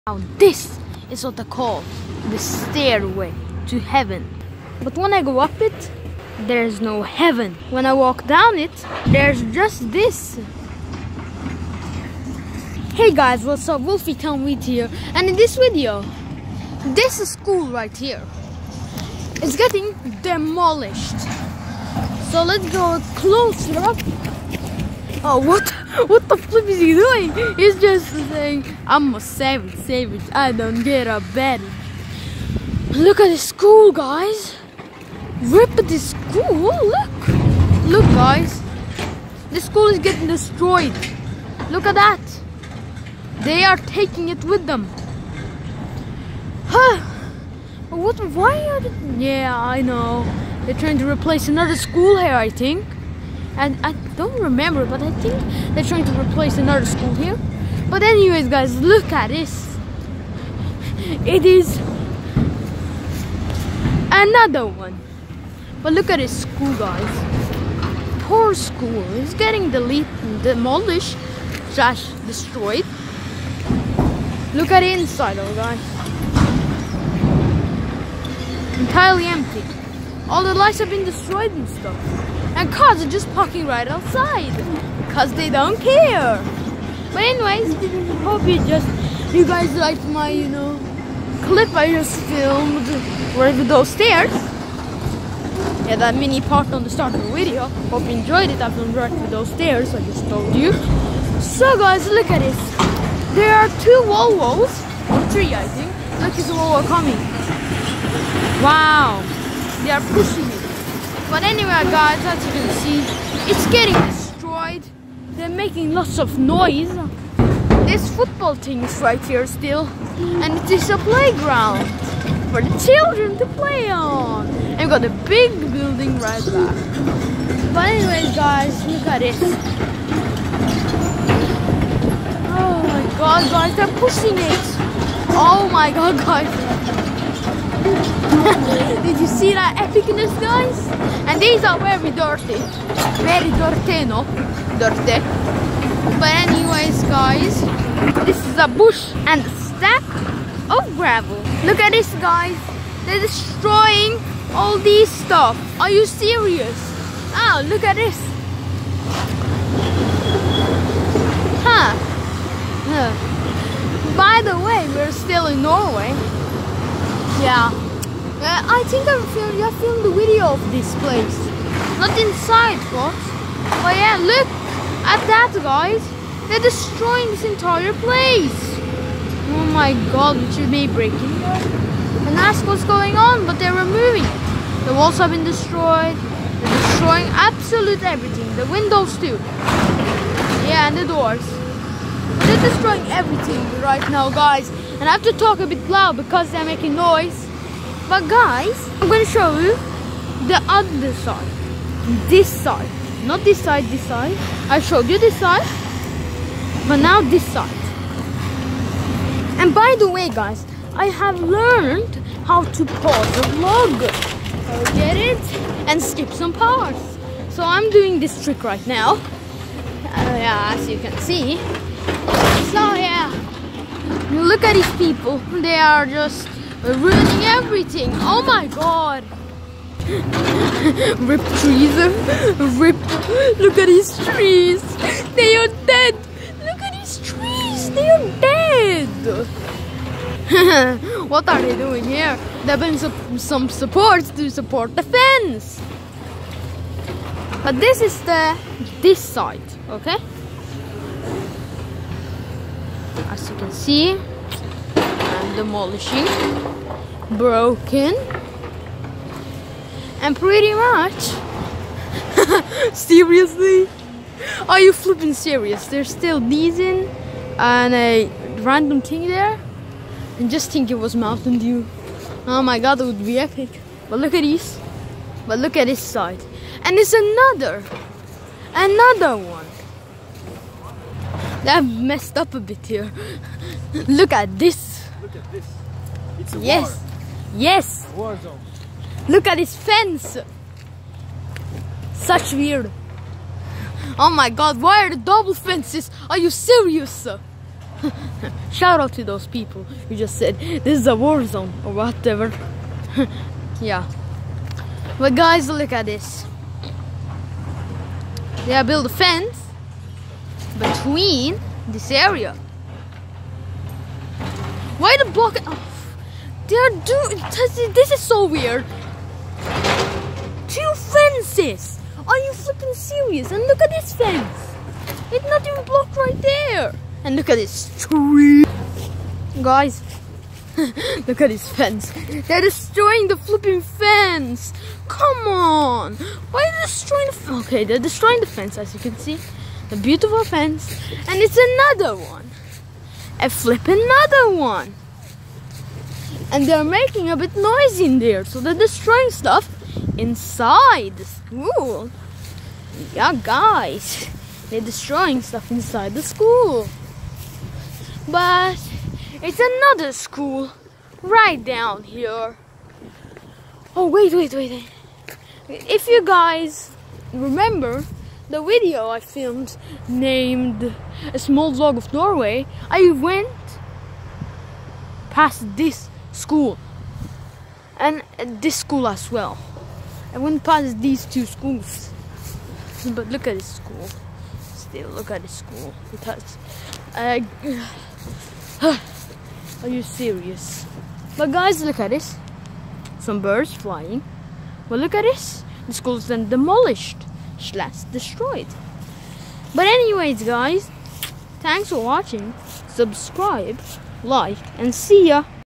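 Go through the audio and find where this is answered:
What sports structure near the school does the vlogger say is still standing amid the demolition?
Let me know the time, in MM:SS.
01:58.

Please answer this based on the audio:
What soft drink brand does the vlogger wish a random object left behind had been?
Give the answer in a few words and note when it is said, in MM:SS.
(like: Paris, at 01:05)
Mountain Dew, at 04:31.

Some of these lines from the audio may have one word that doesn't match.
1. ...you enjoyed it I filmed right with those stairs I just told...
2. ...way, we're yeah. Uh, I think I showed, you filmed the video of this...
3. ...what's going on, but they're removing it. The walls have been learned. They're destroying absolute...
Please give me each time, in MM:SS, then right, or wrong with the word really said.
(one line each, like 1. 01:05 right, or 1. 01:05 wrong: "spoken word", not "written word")
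1. 01:38 right
2. 02:44 wrong: "filmed", not "showed"
3. 03:02 wrong: "destroyed", not "learned".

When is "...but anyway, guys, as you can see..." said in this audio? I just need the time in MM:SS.
01:51.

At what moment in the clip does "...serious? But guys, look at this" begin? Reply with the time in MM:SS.
06:30.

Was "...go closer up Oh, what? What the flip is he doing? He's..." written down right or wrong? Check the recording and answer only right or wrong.
right.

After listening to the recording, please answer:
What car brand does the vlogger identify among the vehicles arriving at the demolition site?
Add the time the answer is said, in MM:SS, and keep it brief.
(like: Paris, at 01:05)
Volvo, at 01:44.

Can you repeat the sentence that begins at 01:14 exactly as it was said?
Look at the inside, all guys.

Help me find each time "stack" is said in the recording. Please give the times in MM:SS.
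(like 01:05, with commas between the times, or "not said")
02:29.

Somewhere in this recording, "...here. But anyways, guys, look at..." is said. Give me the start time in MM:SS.
00:57.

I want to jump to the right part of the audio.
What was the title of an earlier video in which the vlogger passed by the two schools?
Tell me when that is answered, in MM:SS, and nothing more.
06:11.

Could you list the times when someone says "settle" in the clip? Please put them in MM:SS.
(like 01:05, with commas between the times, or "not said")
not said.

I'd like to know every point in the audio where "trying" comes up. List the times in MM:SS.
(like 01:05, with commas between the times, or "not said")
00:50, 00:55.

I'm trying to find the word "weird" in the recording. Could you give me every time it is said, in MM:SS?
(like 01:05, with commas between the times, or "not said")
04:52, 05:18.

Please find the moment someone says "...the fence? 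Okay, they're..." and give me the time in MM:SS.
05:37.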